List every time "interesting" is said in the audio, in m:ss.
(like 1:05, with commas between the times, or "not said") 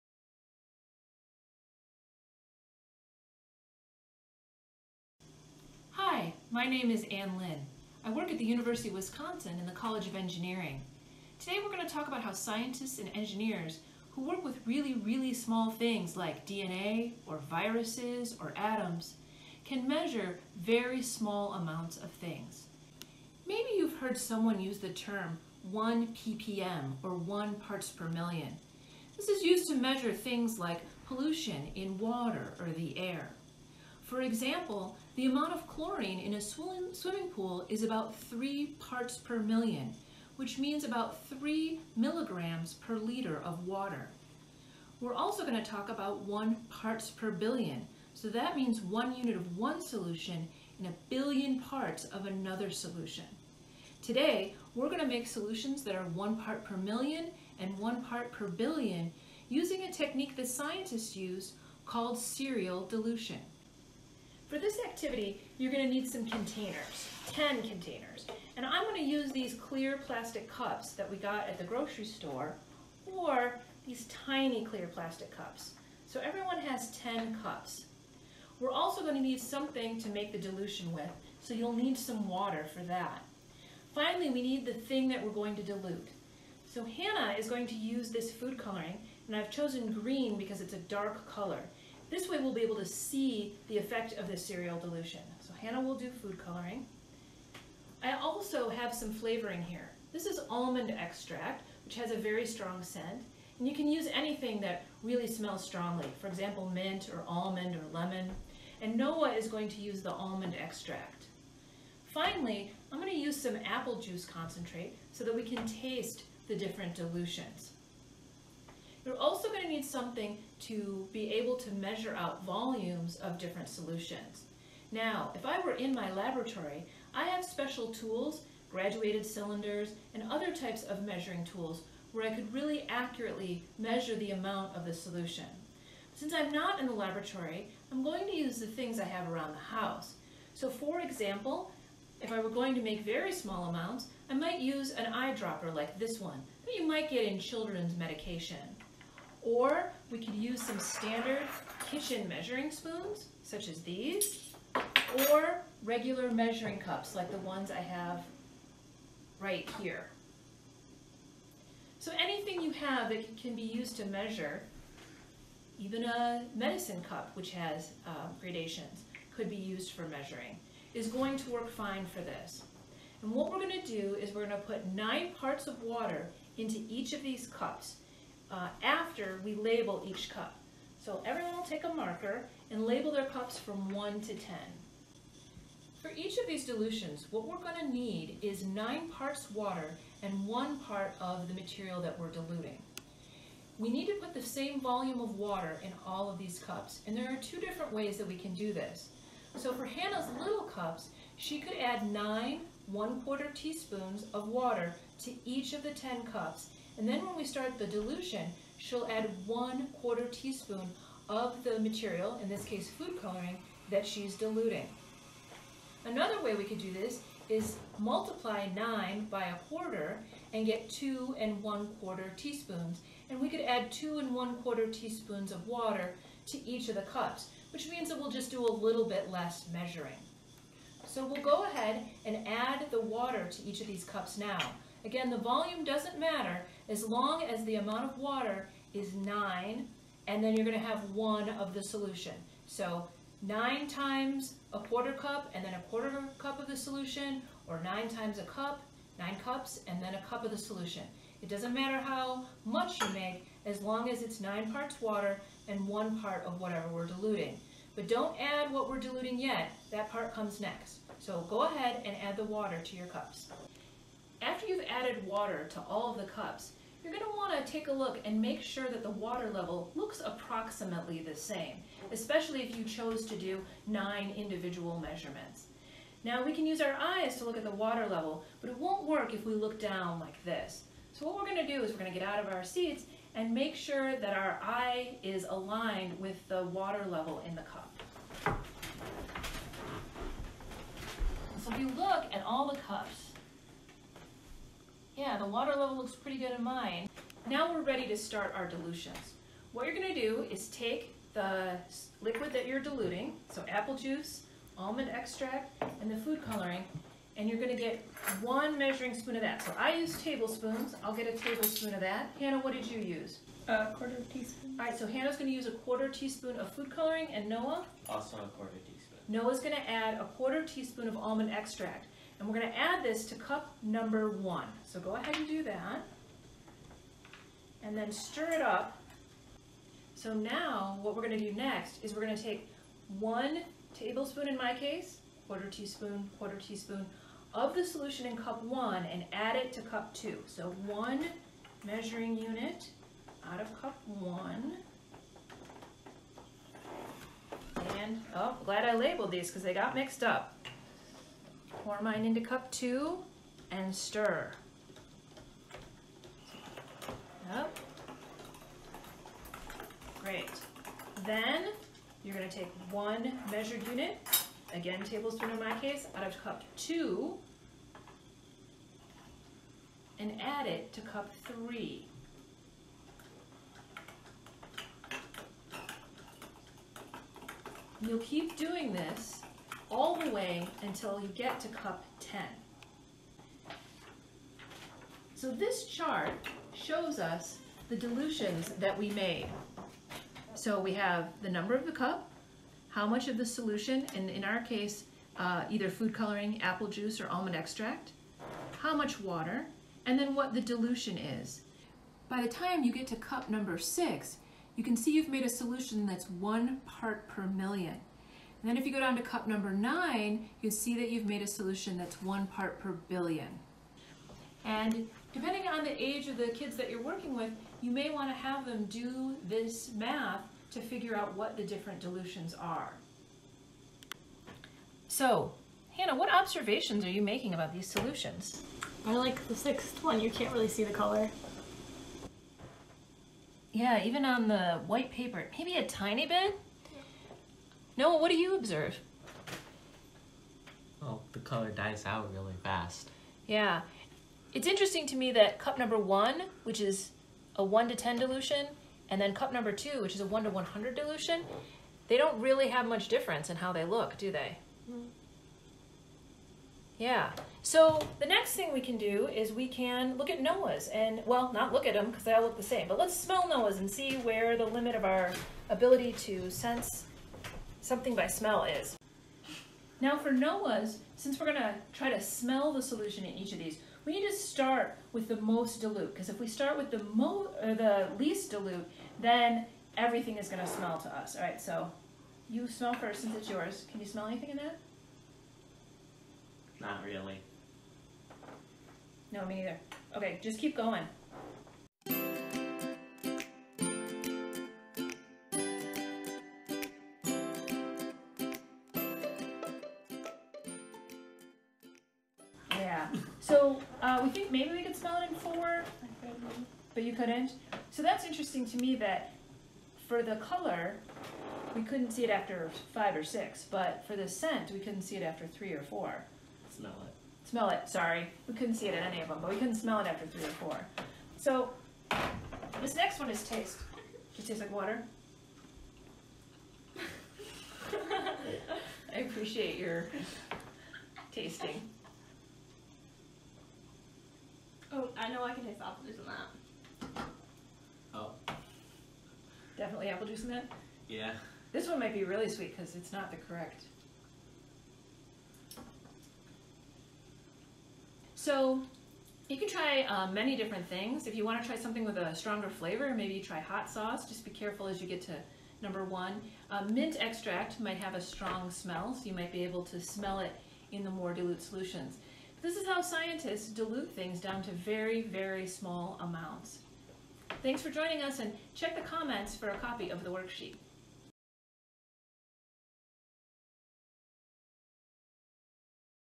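7:24, 8:28.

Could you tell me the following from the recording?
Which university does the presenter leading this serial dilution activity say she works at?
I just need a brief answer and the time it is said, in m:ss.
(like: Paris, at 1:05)
University of Wisconsin, at 0:08.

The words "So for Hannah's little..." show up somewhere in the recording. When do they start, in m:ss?
3:19.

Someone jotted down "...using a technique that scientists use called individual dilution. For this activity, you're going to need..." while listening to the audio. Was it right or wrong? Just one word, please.
wrong.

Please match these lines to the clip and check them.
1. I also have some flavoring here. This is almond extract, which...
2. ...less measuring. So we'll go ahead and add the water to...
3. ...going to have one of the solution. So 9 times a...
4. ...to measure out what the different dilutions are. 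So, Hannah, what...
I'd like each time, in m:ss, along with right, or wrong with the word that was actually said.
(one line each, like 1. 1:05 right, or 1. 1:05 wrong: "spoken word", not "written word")
1. 1:38 right
2. 3:49 right
3. 4:00 right
4. 7:00 wrong: "figure", not "measure".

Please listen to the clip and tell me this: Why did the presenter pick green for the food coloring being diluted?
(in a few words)
it's a dark color.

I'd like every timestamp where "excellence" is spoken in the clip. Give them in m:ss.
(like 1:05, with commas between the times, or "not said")
not said.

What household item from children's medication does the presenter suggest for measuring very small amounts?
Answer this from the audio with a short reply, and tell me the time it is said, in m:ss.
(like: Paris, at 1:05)
eyedropper, at 2:24.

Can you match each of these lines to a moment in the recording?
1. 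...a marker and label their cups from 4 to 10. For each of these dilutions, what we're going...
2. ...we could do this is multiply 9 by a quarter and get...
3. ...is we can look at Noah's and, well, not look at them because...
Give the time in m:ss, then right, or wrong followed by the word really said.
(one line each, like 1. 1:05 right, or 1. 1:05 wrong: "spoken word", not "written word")
1. 3:01 wrong: "1", not "4"
2. 3:36 right
3. 7:39 right.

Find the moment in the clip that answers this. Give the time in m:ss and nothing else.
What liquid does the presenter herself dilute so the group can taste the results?
1:53.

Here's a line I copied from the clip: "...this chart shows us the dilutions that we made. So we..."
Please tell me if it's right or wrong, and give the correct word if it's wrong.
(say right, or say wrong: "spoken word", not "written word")
right.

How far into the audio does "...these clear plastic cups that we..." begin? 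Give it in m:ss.
1:09.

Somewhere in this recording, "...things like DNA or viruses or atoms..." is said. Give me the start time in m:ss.
0:15.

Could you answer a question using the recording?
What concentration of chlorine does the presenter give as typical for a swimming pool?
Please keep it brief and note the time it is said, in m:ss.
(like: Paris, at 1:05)
3 parts per million, at 0:37.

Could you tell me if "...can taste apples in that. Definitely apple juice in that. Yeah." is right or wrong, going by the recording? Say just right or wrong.
right.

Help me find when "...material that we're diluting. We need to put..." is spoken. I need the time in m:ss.
3:11.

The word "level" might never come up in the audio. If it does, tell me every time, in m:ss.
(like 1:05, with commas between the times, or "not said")
4:29, 4:38, 4:47, 4:55.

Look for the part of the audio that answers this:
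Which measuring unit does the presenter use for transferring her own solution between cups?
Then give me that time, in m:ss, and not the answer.
5:10.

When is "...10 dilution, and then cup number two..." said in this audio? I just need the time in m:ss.
7:27.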